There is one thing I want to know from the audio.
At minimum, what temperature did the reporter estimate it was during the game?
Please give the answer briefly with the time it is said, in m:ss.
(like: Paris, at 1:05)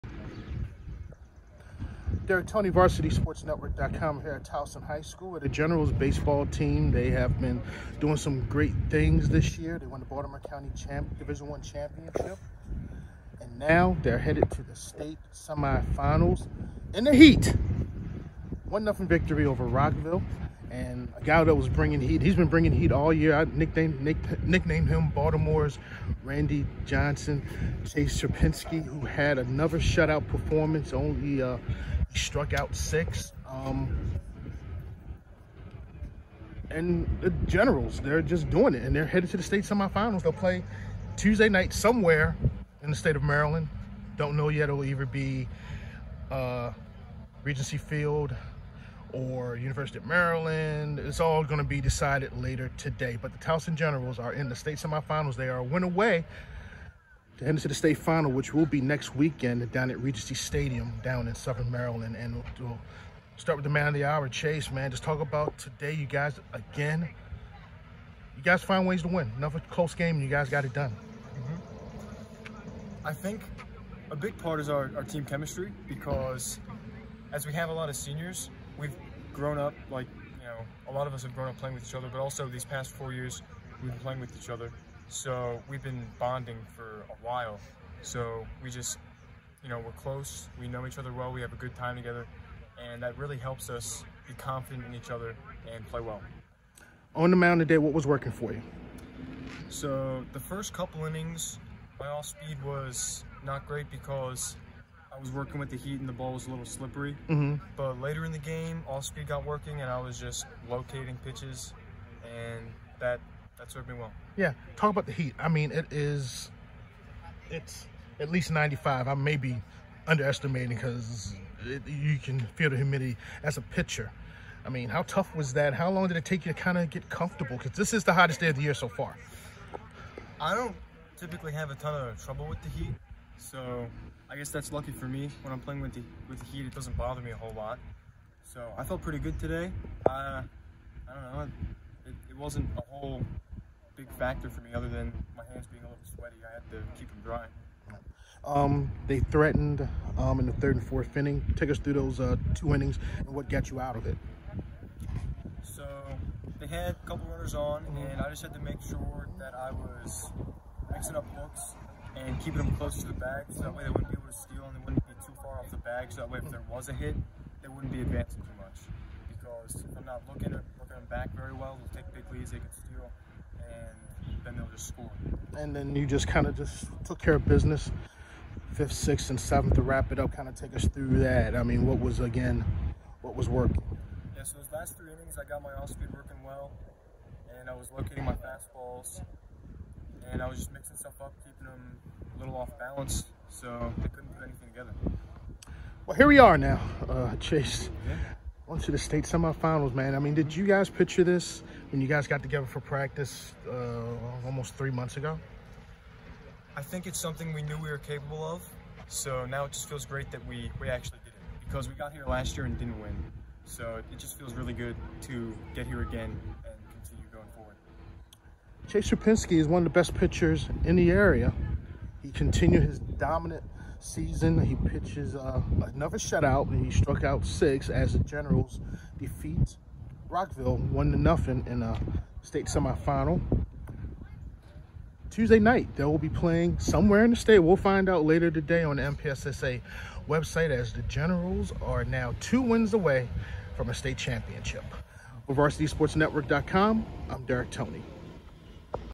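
95, at 1:58.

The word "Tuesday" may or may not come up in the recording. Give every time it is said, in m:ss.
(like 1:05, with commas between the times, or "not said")
0:41, 3:55.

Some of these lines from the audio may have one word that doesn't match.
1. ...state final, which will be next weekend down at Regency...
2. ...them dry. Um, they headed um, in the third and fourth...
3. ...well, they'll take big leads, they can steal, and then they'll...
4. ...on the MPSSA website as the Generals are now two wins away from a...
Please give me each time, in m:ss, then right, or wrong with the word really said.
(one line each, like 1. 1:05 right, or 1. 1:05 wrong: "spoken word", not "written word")
1. 0:57 right
2. 2:27 wrong: "threatened", not "headed"
3. 2:51 right
4. 3:58 right.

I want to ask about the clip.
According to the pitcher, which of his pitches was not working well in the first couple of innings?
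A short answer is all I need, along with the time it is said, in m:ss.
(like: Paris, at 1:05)
Off speed, at 1:42.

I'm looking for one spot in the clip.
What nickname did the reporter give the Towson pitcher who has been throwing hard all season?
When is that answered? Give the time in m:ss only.
0:25.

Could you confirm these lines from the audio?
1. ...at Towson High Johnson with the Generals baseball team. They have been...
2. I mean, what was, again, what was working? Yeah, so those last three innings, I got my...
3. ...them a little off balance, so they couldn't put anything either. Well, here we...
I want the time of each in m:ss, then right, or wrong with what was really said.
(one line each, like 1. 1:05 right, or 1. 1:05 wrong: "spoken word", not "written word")
1. 0:04 wrong: "School", not "Johnson"
2. 3:01 right
3. 3:11 wrong: "together", not "either".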